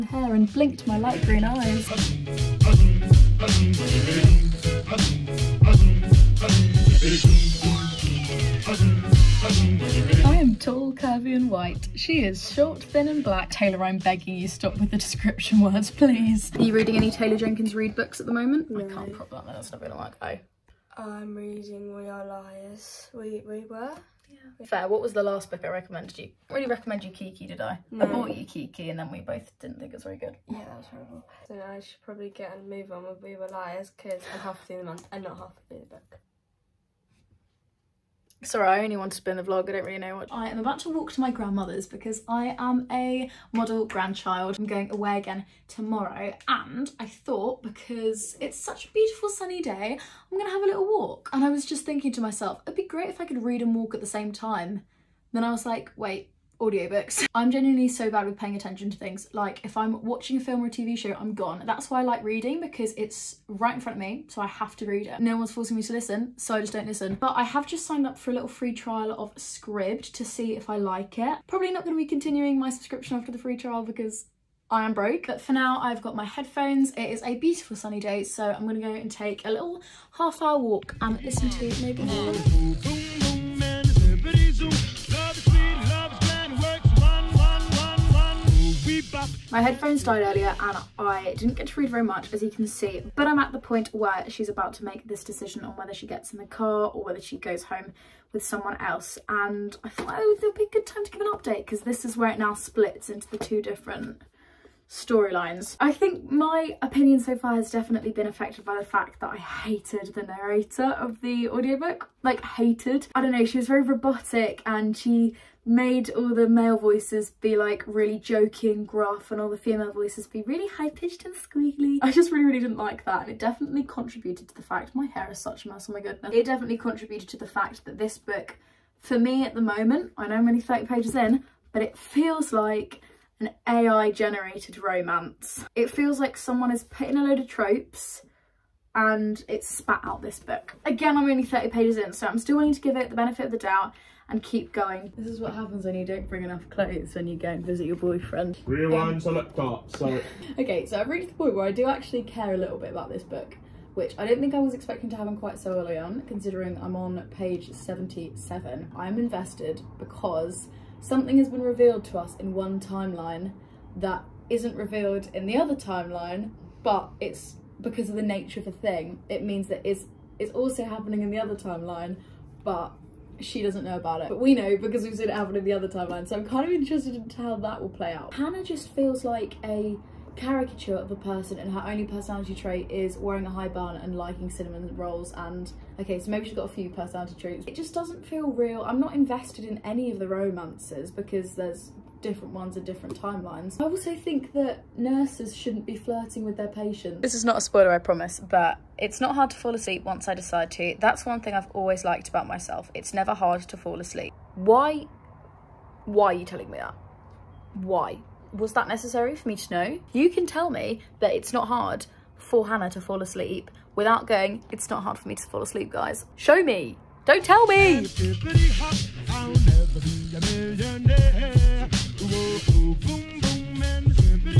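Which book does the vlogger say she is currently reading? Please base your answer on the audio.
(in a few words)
We Are Liars.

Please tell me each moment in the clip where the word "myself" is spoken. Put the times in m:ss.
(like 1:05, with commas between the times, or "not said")
0:52, 3:22.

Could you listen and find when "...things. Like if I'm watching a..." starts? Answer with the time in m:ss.
0:58.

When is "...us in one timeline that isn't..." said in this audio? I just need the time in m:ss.
2:42.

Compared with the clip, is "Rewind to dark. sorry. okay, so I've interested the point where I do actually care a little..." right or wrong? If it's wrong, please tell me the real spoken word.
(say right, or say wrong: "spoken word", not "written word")
wrong: "reached", not "interested".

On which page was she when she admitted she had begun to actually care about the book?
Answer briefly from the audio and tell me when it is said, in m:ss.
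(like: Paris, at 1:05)
77, at 2:37.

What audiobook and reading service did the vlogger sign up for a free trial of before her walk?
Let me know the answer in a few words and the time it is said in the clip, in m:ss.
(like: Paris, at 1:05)
Scribd, at 1:09.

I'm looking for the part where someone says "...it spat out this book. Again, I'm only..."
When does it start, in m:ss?
2:19.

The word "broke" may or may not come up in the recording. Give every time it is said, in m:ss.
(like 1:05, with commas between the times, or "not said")
1:14.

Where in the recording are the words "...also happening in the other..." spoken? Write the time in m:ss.
2:50.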